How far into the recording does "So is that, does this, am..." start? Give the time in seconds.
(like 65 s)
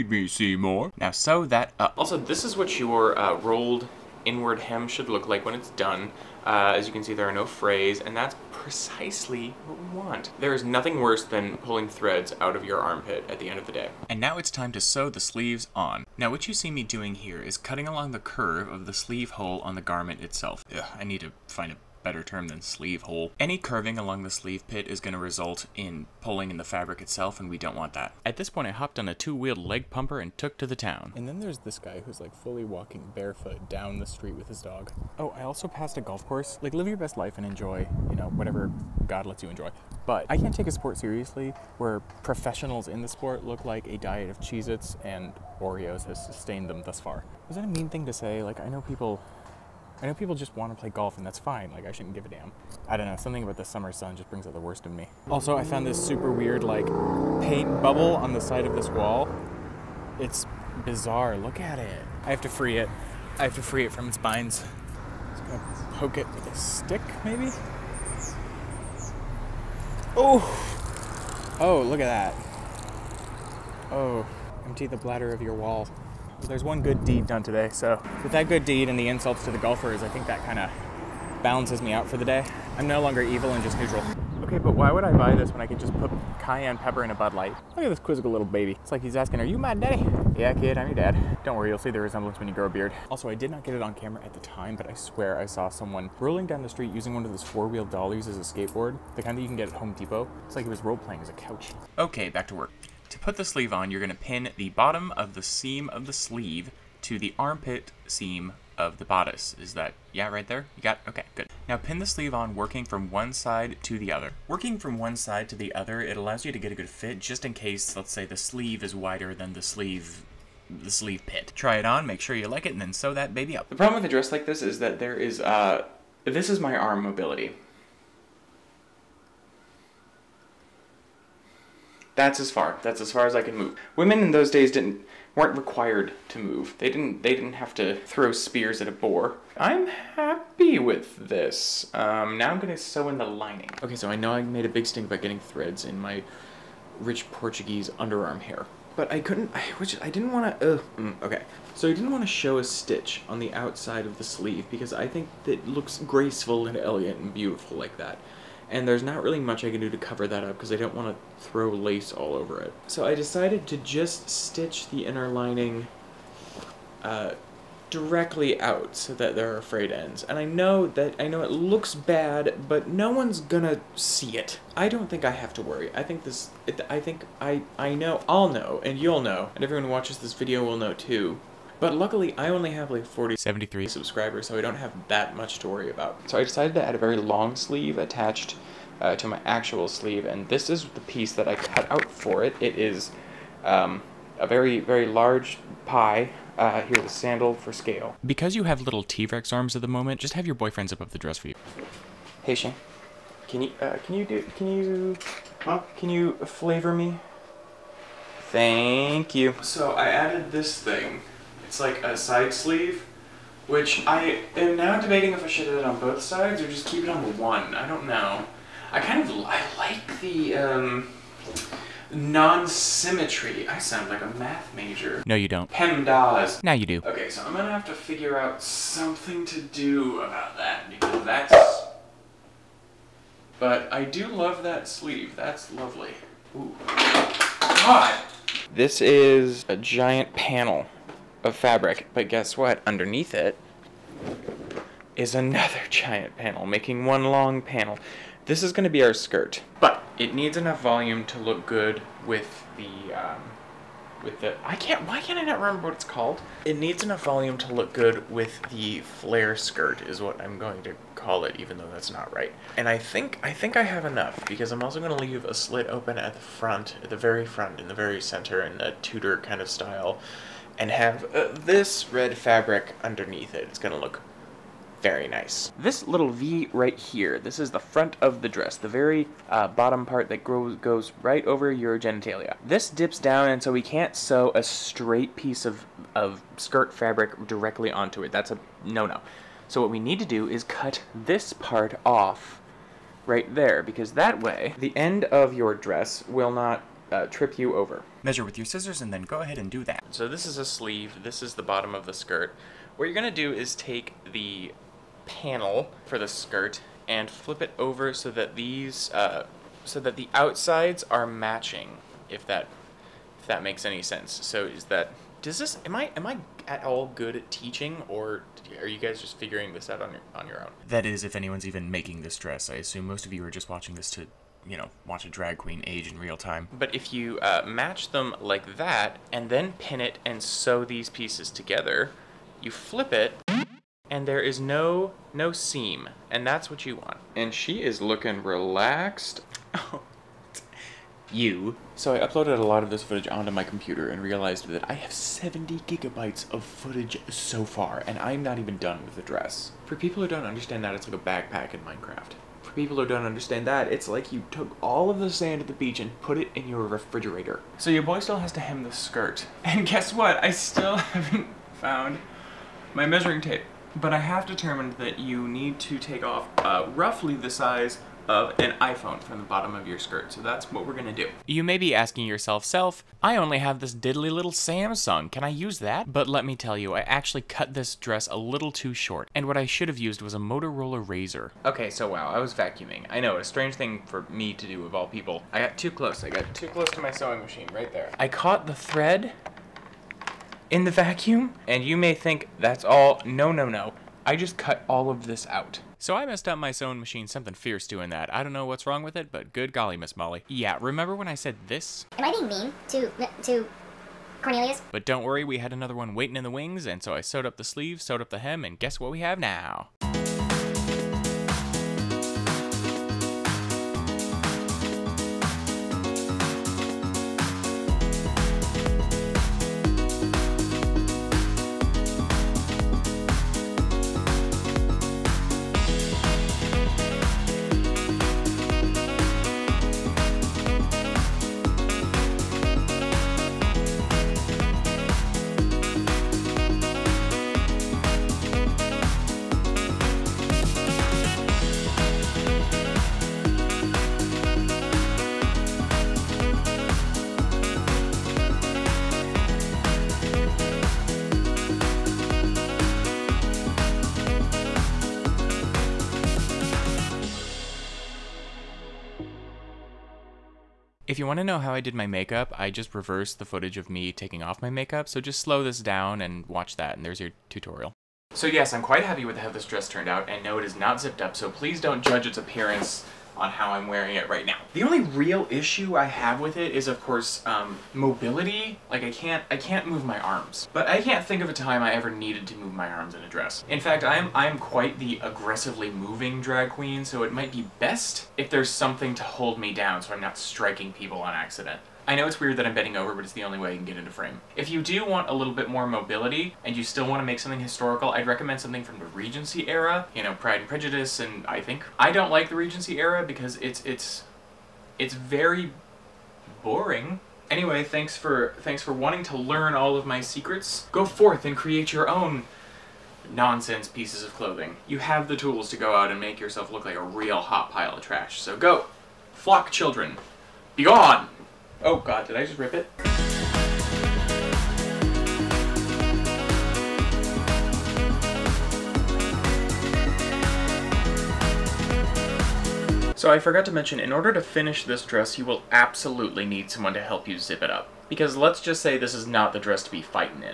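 314 s.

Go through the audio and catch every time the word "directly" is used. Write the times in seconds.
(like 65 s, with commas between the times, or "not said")
167 s, 287 s.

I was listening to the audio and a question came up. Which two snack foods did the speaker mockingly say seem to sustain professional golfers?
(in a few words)
Cheez-Its and Oreos.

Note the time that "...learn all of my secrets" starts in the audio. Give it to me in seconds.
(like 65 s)
509 s.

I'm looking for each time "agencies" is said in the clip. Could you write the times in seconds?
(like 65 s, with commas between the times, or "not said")
not said.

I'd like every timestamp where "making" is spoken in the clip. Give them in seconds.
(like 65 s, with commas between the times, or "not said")
246 s, 321 s.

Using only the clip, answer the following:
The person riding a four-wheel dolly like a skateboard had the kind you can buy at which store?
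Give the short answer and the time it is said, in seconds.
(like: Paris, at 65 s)
Home Depot, at 99 s.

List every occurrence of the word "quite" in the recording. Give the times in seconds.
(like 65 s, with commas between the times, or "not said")
468 s, 484 s.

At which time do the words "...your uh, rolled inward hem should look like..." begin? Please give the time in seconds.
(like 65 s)
2 s.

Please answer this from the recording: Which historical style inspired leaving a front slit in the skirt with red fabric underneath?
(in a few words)
Tudor.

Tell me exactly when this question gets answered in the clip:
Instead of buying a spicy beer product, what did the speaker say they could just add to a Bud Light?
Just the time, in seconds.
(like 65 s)
86 s.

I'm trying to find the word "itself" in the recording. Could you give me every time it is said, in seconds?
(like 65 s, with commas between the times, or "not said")
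20 s, 26 s.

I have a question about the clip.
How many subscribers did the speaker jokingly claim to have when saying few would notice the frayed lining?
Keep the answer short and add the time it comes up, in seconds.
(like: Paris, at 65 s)
73, at 183 s.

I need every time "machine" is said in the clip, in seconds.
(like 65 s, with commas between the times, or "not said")
387 s, 396 s.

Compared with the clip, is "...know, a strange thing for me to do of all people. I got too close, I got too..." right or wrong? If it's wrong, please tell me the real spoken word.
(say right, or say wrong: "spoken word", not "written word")
right.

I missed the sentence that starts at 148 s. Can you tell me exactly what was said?
But I couldn't, I, which I didn't want to, uh, mm, okay.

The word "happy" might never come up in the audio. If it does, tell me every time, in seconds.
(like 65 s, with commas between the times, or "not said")
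139 s, 469 s.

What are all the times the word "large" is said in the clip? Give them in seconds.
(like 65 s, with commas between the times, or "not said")
195 s.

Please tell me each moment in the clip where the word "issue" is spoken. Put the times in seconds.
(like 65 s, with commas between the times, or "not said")
475 s.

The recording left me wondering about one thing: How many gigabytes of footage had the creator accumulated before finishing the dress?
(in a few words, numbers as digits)
70.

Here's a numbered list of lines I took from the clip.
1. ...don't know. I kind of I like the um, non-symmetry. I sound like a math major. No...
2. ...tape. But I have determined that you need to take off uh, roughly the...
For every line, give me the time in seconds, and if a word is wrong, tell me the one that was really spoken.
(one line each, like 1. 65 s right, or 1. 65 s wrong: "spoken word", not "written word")
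1. 217 s right
2. 363 s right.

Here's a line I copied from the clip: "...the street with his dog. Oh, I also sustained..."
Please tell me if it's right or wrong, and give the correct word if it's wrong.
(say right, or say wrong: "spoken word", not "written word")
wrong: "passed", not "sustained".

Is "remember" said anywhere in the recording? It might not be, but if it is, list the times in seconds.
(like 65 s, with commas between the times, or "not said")
255 s, 400 s.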